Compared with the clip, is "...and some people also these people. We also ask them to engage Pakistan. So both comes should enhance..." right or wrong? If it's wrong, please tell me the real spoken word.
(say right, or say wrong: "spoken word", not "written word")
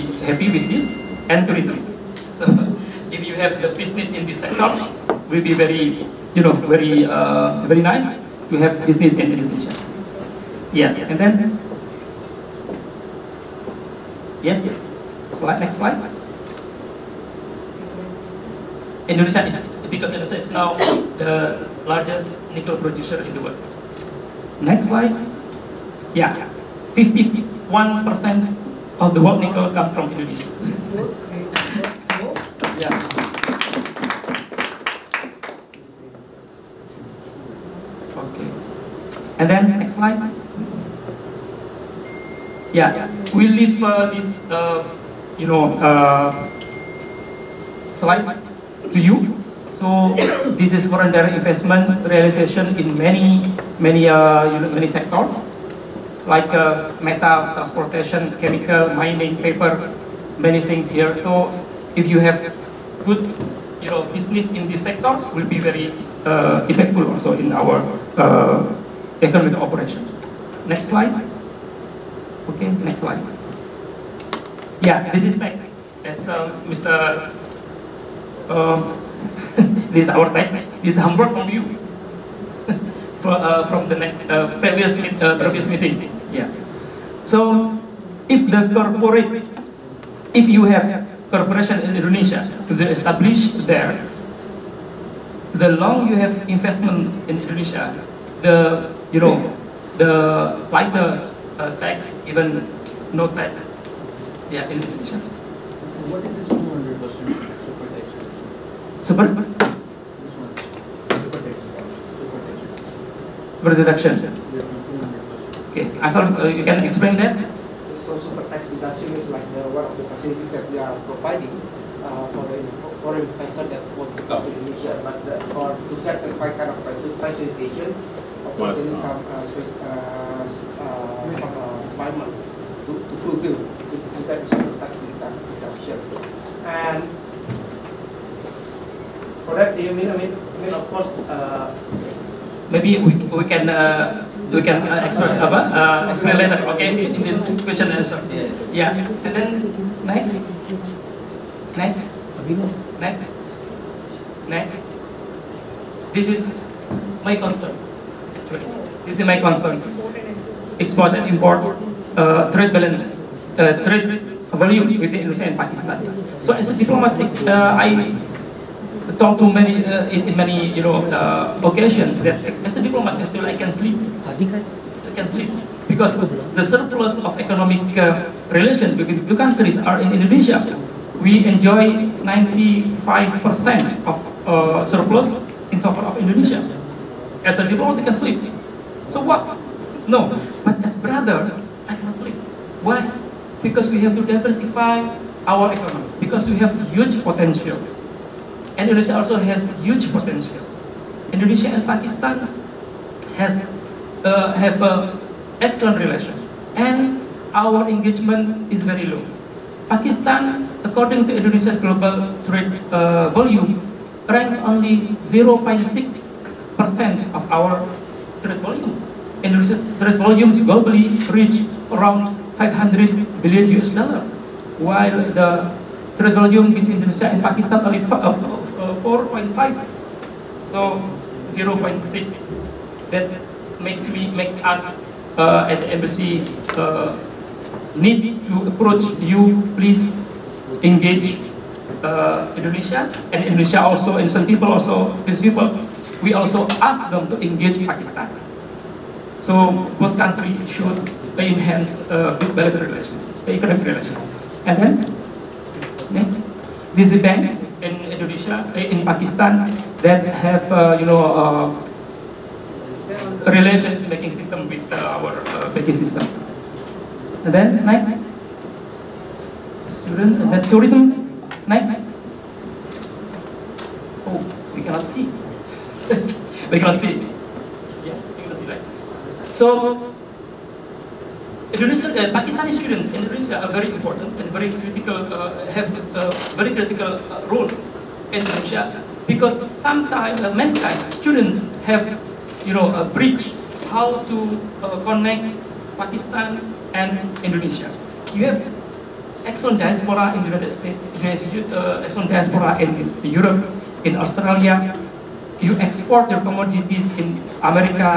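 wrong: "countries", not "comes".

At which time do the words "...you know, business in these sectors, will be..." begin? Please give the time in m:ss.
1:03.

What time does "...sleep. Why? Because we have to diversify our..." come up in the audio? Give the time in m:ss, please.
3:12.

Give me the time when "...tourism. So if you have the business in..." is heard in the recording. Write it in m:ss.
0:01.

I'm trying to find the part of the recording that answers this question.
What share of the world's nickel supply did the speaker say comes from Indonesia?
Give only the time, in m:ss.
0:26.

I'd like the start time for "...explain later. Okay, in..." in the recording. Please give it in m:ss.
2:26.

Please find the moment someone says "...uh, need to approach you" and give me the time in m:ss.
3:56.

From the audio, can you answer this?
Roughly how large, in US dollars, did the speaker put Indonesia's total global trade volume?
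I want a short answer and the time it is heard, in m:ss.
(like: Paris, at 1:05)
500 billion US dollars, at 3:42.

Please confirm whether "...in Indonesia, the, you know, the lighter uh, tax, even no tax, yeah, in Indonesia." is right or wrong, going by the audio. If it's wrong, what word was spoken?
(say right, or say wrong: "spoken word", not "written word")
right.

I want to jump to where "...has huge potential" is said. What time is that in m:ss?
3:19.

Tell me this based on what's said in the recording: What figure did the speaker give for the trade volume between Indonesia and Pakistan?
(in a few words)
4.5.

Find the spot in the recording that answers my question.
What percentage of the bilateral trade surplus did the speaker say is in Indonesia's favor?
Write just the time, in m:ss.
3:02.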